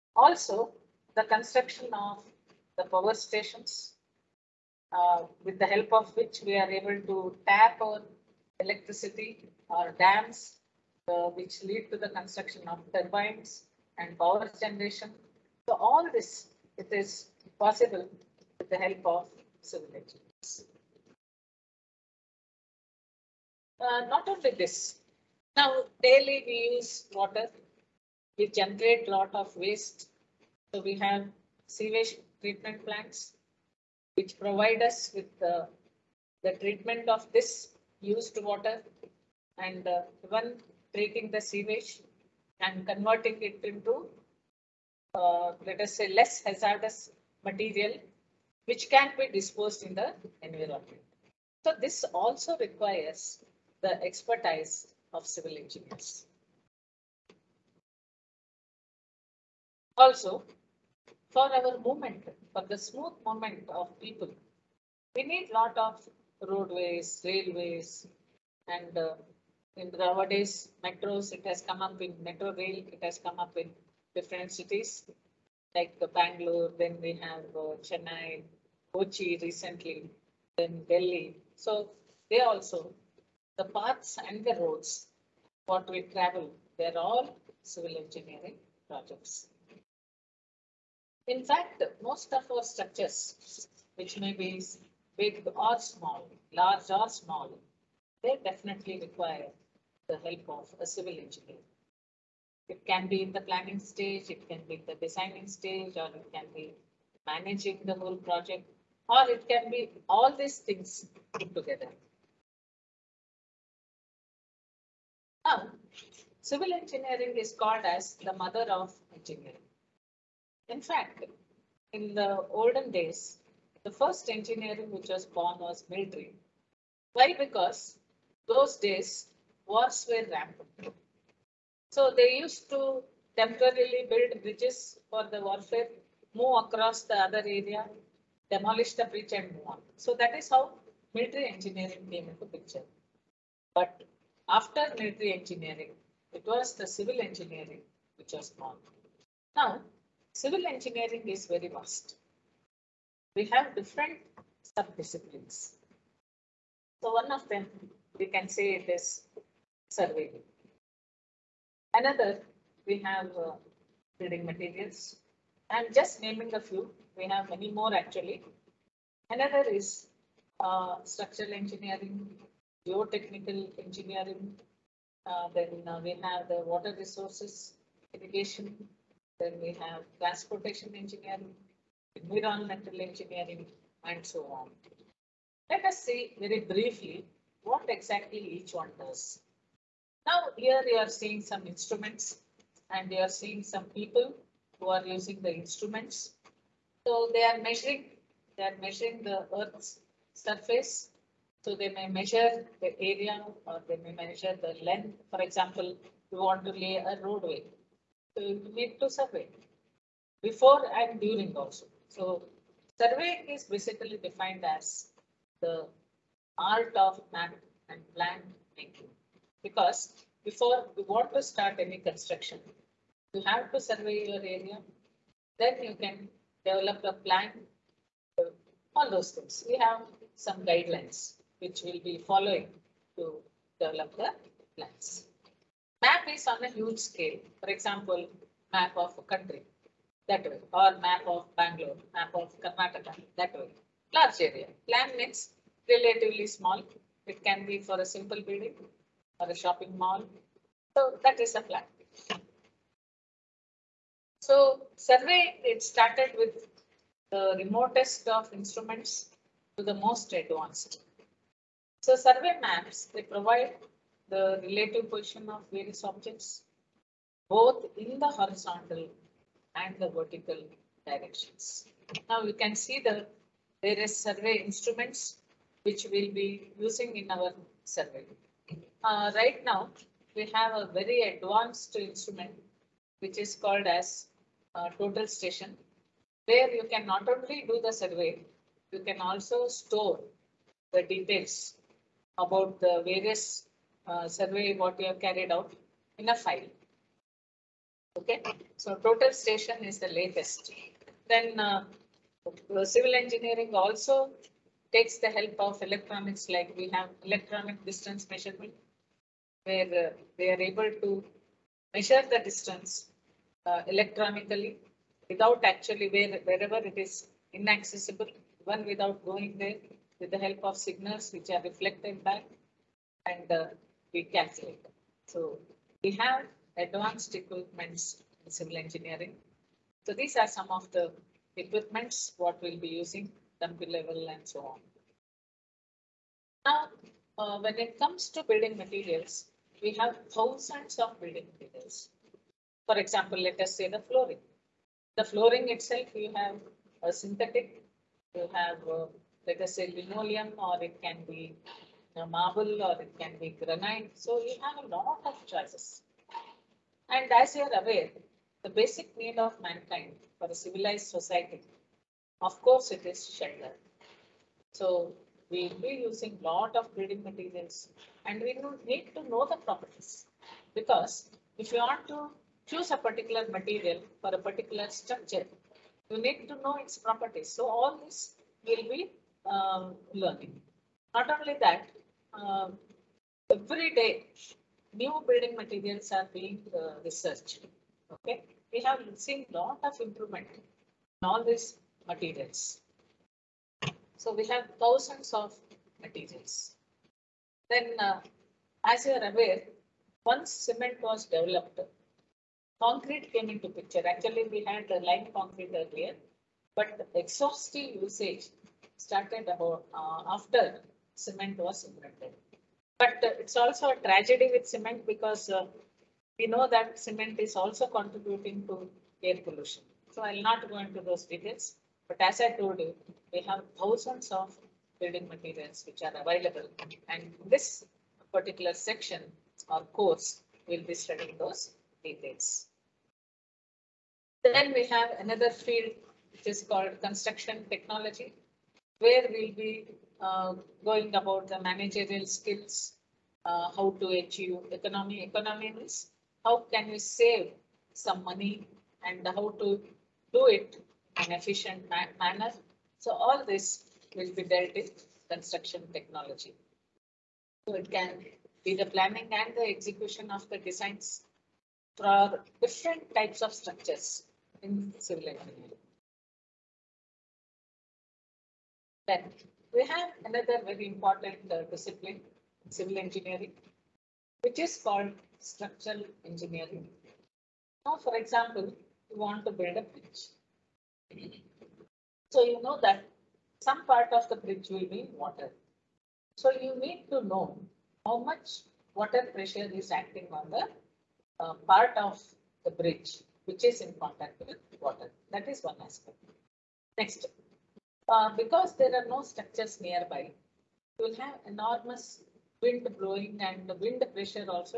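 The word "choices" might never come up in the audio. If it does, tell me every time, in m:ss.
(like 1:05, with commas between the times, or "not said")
5:55.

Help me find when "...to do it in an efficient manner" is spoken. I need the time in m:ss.
7:29.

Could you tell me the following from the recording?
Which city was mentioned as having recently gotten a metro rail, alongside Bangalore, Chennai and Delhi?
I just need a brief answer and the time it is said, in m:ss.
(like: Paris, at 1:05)
Kochi, at 1:18.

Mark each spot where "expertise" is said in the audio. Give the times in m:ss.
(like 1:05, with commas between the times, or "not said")
0:54.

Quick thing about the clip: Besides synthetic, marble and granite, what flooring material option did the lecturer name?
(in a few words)
Linoleum.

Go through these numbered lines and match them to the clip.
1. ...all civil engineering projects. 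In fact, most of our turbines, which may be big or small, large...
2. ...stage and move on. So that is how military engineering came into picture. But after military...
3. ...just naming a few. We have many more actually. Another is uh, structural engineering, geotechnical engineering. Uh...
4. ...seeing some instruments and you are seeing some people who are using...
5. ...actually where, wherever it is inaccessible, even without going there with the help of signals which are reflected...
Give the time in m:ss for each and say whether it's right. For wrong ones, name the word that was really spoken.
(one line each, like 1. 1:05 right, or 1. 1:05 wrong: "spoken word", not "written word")
1. 1:26 wrong: "structures", not "turbines"
2. 2:19 wrong: "bridge", not "stage"
3. 2:45 right
4. 3:11 right
5. 5:15 right.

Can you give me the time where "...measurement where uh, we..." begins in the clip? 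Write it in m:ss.
5:08.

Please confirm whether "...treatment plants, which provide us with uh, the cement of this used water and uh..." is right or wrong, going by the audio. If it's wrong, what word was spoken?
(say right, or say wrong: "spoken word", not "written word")
wrong: "treatment", not "cement".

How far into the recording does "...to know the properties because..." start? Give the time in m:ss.
6:09.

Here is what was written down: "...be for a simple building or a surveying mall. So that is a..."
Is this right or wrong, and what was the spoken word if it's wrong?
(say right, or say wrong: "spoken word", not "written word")
wrong: "shopping", not "surveying".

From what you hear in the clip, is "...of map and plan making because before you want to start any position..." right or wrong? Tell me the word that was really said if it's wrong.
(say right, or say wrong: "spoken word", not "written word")
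wrong: "construction", not "position".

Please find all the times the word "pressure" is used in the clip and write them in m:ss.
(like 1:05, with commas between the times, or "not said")
8:09, 8:24.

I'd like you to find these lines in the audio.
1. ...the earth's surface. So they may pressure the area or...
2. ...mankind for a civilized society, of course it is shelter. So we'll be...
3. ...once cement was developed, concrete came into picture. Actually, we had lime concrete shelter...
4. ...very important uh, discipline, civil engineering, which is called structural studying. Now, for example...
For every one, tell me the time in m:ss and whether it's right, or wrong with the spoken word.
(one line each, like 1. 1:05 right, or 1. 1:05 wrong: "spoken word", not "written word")
1. 3:19 wrong: "measure", not "pressure"
2. 5:59 right
3. 6:40 wrong: "earlier", not "shelter"
4. 7:50 wrong: "engineering", not "studying".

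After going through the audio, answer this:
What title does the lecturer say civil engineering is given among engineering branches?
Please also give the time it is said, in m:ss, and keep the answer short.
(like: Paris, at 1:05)
Mother of engineering, at 1:58.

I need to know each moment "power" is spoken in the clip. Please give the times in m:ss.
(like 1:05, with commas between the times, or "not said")
0:02, 0:14.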